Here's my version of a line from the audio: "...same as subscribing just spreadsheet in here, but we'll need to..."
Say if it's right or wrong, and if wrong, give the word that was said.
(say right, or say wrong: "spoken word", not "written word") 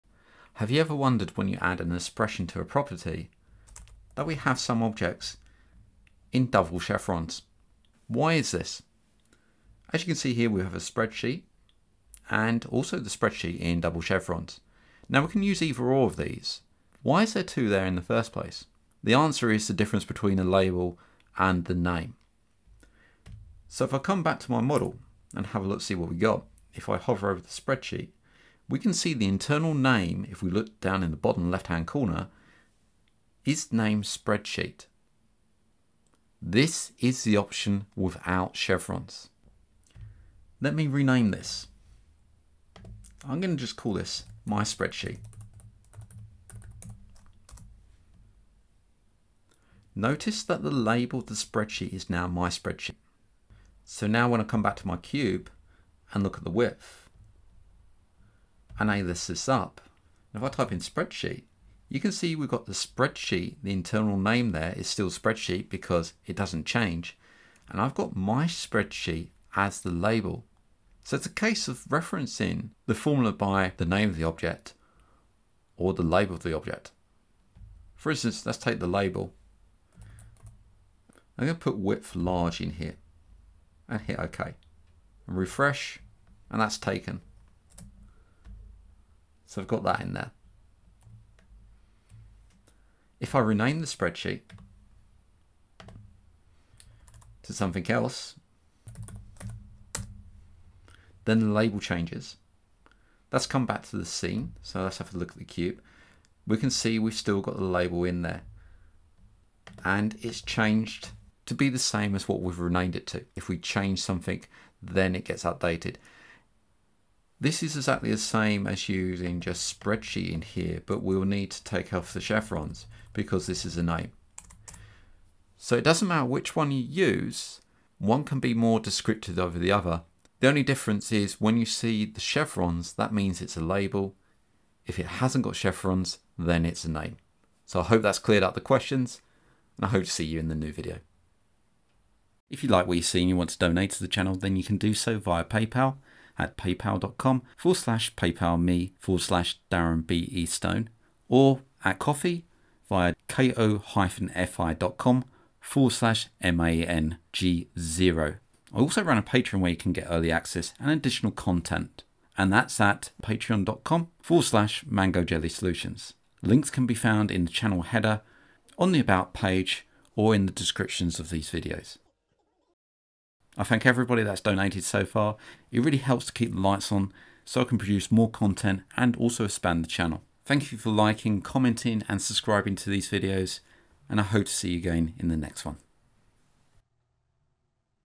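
wrong: "using", not "subscribing".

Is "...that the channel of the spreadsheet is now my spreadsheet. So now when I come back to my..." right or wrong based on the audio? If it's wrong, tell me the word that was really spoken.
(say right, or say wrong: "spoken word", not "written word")
wrong: "label", not "channel".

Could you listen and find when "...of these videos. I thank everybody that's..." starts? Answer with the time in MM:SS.
02:51.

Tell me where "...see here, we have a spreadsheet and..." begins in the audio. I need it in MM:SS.
00:10.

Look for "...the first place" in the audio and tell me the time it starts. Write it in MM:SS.
00:17.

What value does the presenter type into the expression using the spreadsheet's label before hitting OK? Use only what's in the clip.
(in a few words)
width large.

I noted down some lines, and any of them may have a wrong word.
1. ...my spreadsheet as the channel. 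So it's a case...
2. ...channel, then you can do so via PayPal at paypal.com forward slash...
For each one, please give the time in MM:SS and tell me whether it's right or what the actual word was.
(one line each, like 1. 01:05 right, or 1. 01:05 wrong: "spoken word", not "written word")
1. 01:08 wrong: "label", not "channel"
2. 02:24 right.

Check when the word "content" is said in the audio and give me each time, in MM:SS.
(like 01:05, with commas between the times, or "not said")
02:41, 02:58.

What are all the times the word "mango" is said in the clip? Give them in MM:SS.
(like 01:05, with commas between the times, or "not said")
02:44.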